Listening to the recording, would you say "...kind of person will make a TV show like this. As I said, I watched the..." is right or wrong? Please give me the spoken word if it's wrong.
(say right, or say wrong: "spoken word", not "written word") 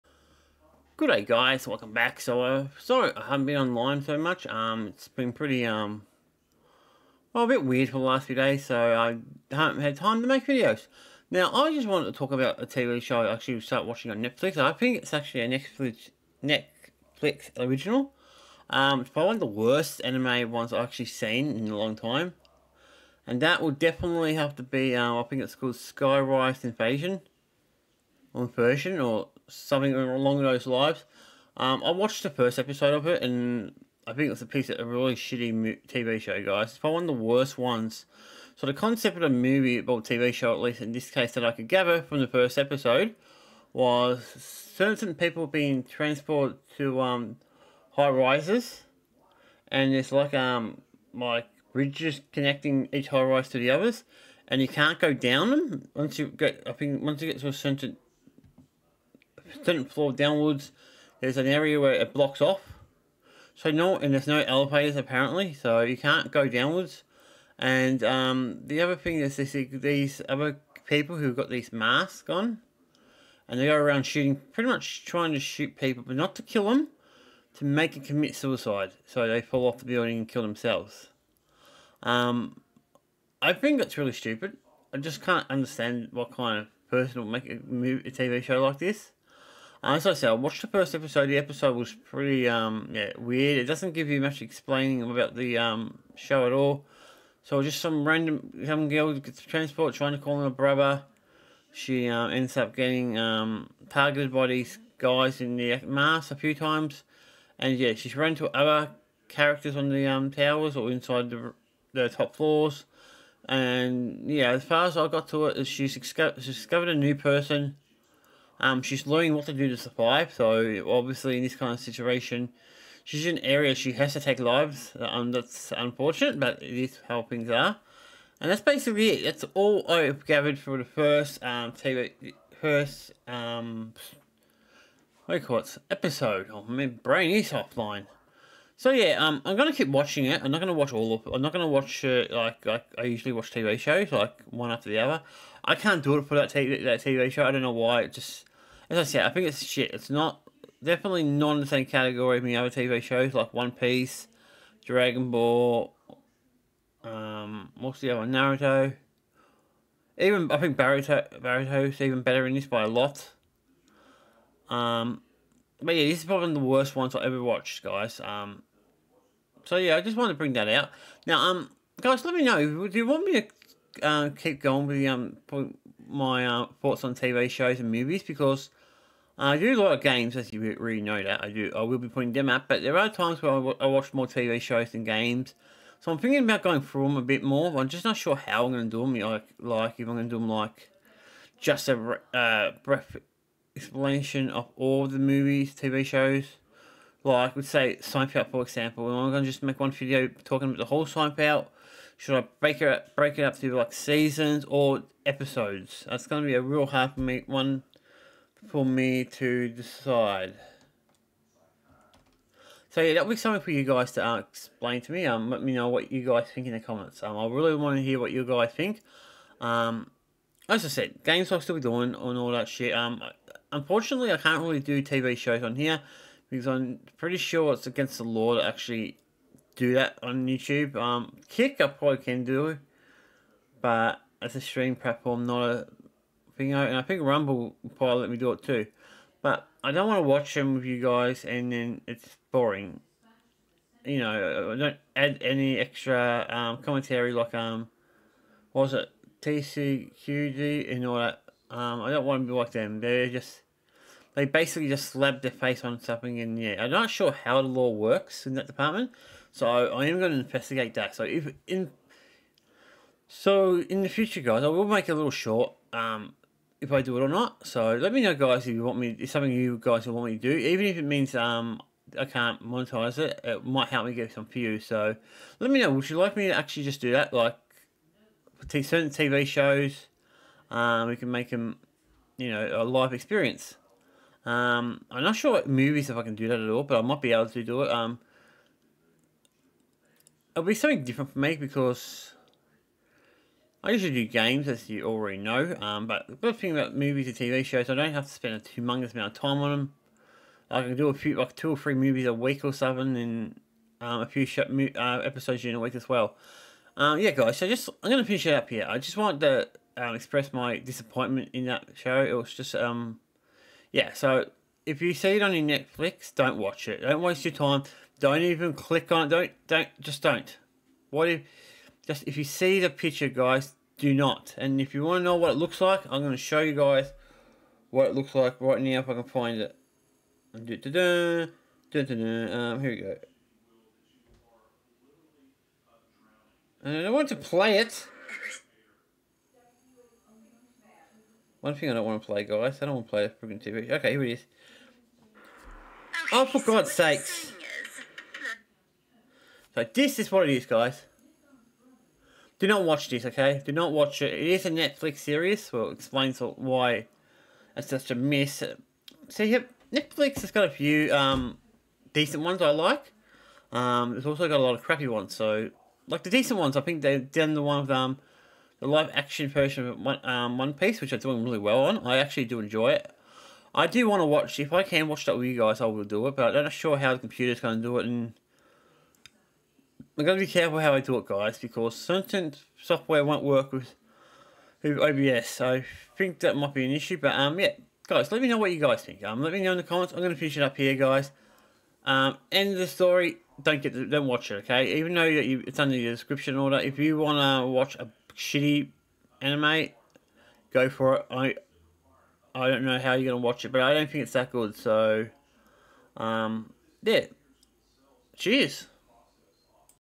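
right.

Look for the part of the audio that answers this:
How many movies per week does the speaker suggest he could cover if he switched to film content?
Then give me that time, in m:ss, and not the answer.
5:01.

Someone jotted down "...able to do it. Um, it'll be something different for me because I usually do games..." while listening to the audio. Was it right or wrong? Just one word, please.
right.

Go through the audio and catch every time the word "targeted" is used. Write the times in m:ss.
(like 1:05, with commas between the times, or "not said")
1:43.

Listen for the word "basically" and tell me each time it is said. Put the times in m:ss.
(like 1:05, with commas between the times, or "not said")
2:08, 4:14.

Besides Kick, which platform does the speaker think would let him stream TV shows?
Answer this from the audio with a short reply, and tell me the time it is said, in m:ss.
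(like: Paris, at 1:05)
Rumble, at 3:57.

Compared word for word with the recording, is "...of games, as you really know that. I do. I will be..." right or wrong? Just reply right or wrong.
right.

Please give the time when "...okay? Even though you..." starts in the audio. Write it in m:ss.
6:34.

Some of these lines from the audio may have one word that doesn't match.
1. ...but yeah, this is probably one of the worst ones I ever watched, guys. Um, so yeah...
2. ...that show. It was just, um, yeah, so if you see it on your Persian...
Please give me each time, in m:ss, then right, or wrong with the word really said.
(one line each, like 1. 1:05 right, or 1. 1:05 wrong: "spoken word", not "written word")
1. 2:45 right
2. 5:11 wrong: "Netflix", not "Persian".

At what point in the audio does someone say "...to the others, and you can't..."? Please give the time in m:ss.
0:53.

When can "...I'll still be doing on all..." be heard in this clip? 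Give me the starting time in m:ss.
3:41.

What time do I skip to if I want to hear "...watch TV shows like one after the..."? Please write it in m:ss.
2:23.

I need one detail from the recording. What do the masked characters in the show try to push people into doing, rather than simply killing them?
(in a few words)
Commit suicide.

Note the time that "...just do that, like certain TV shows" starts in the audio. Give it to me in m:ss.
4:36.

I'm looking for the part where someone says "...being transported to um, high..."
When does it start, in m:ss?
0:45.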